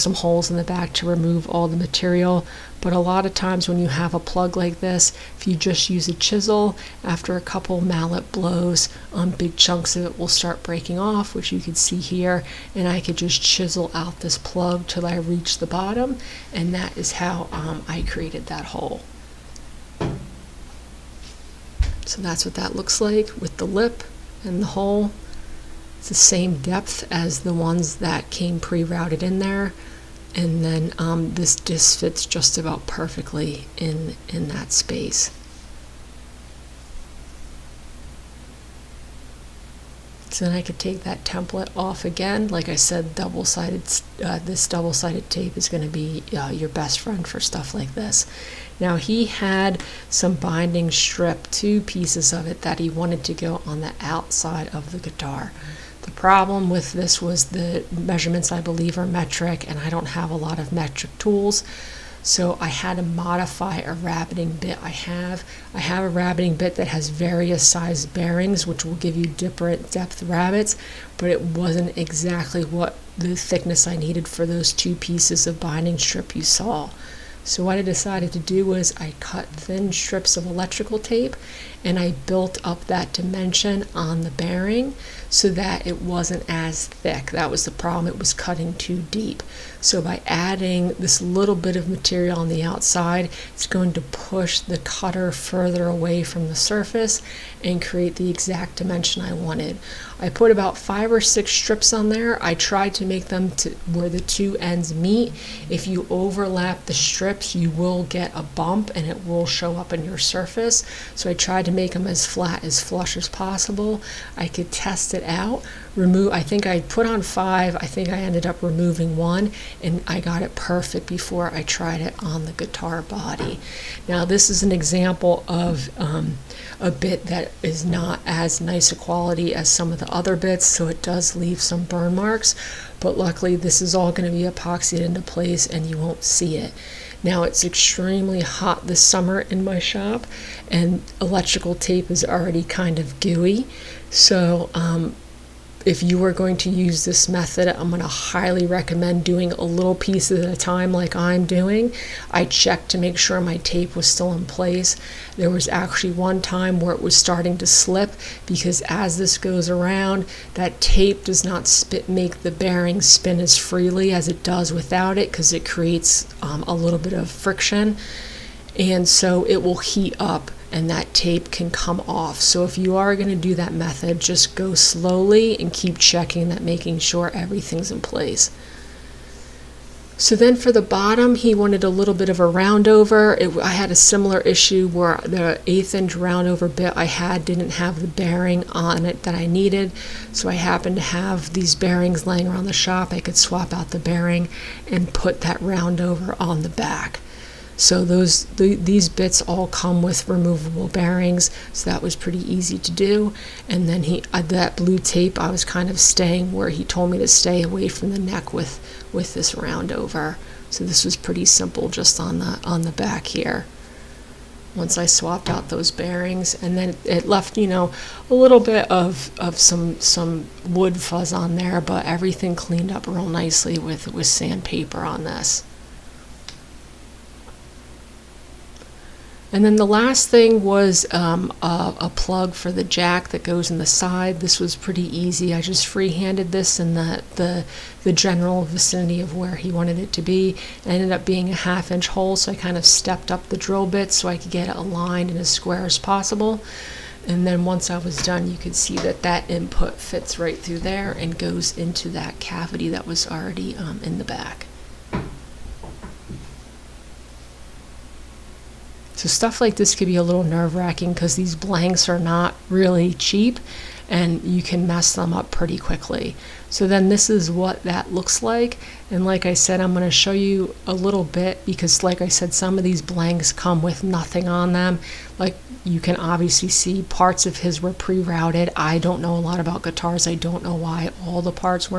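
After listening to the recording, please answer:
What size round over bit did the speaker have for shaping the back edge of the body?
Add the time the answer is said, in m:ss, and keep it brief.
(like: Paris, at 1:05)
1/8 inch, at 3:05.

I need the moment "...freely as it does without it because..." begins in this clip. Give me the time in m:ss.
2:43.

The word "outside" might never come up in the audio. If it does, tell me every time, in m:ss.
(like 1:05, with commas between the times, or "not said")
0:54, 1:32.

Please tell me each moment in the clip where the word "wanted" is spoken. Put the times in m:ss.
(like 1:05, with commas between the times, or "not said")
0:52, 1:39, 3:01, 3:59.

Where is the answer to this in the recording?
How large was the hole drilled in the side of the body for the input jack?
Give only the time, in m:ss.
4:01.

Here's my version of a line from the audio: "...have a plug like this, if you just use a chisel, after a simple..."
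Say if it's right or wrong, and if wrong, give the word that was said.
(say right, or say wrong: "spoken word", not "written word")
wrong: "couple", not "simple".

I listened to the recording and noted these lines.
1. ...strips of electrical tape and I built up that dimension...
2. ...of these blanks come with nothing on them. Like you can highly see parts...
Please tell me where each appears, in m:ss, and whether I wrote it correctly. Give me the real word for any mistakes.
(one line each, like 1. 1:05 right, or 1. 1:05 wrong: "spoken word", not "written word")
1. 1:19 right
2. 4:32 wrong: "obviously", not "highly".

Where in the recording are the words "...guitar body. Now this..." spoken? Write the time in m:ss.
2:02.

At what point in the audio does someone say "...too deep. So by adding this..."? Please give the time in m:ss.
1:28.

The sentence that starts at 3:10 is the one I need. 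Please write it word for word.
So I happened to have these bearings laying around the shop.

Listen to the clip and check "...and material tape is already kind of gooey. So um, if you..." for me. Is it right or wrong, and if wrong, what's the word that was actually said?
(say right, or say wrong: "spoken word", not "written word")
wrong: "electrical", not "material".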